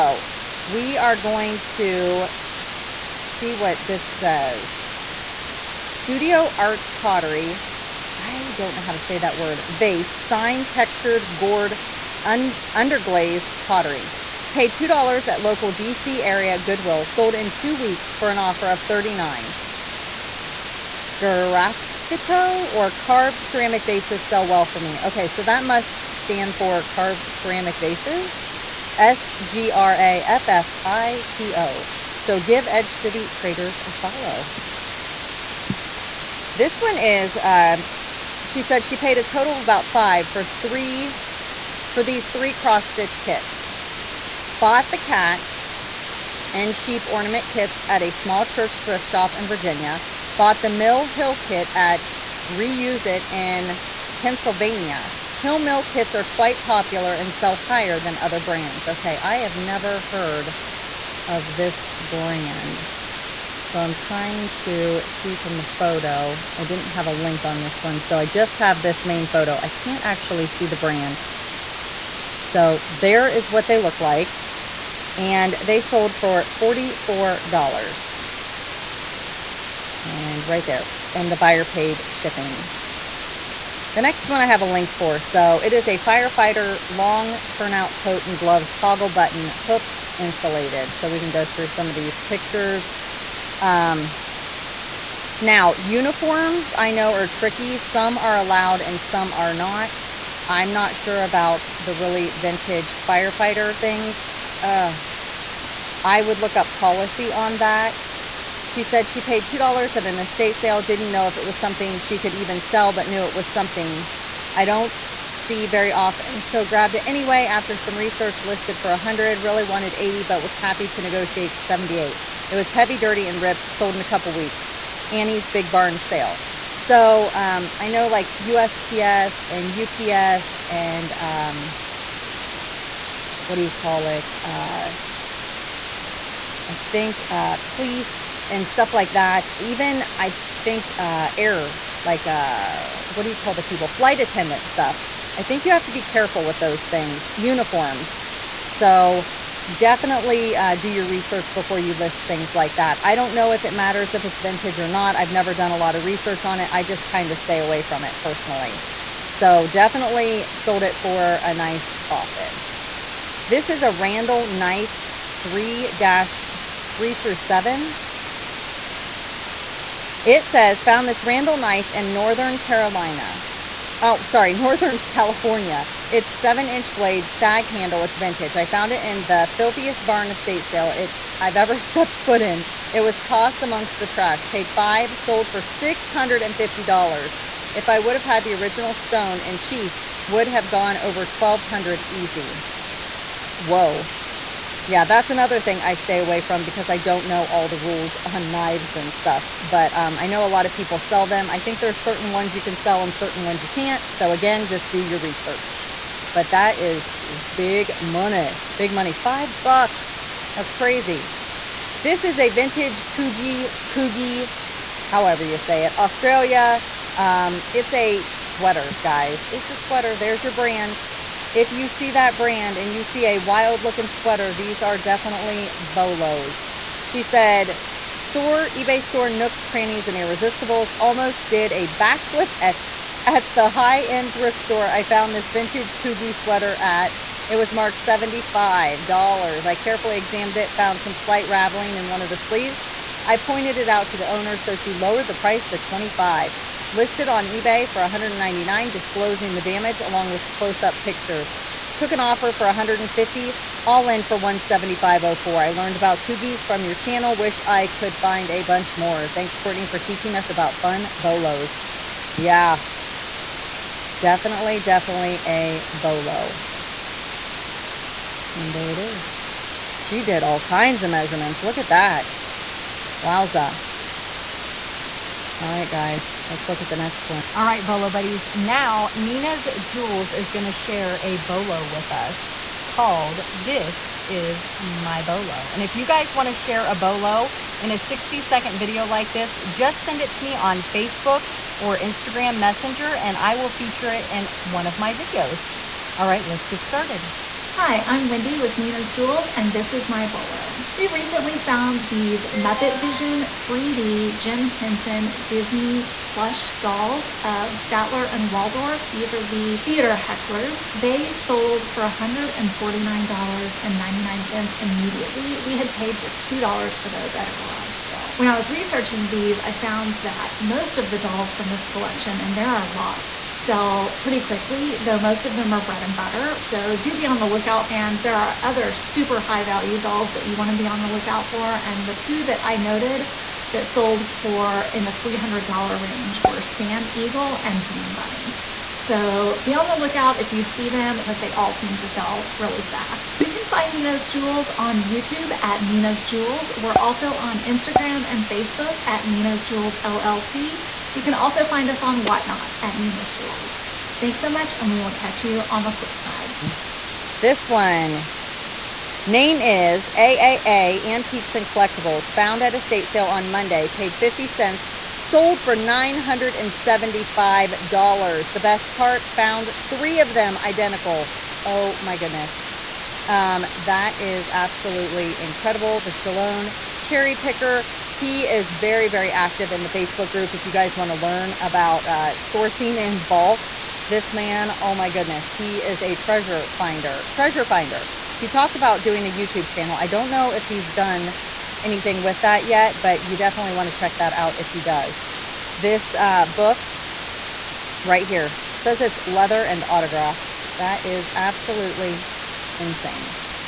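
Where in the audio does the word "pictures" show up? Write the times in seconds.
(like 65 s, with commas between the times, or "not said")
92 s, 251 s.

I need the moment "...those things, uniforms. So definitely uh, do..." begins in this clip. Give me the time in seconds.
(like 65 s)
146 s.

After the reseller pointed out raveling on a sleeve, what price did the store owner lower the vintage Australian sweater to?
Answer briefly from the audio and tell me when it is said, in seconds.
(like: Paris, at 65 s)
$25, at 245 s.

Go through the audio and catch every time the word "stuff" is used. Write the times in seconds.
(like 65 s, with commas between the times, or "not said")
138 s, 144 s, 199 s.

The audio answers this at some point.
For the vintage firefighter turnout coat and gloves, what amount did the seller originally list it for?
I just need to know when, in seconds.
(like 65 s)
118 s.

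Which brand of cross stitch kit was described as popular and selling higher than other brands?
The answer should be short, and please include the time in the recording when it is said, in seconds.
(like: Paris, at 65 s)
Mill Hill, at 50 s.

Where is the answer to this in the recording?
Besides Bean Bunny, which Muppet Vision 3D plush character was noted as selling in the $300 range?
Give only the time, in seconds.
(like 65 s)
336 s.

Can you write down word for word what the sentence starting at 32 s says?
So give Edge City Traders a follow.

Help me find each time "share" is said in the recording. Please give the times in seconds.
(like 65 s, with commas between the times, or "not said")
280 s, 286 s.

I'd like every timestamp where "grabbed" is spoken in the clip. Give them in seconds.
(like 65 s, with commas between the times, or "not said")
116 s.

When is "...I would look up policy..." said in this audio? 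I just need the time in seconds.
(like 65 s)
106 s.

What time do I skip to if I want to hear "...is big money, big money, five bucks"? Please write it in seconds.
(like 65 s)
206 s.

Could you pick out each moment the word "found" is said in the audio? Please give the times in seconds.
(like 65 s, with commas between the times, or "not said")
170 s, 178 s, 235 s, 240 s, 301 s, 319 s, 362 s, 369 s.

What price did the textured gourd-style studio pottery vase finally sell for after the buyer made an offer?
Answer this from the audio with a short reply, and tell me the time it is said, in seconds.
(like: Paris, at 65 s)
$39, at 18 s.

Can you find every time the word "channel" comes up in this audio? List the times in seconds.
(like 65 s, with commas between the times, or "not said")
256 s, 389 s.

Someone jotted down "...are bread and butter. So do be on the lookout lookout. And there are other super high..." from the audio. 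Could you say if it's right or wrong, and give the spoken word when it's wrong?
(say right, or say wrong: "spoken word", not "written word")
right.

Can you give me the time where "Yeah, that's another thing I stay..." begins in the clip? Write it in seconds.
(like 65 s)
194 s.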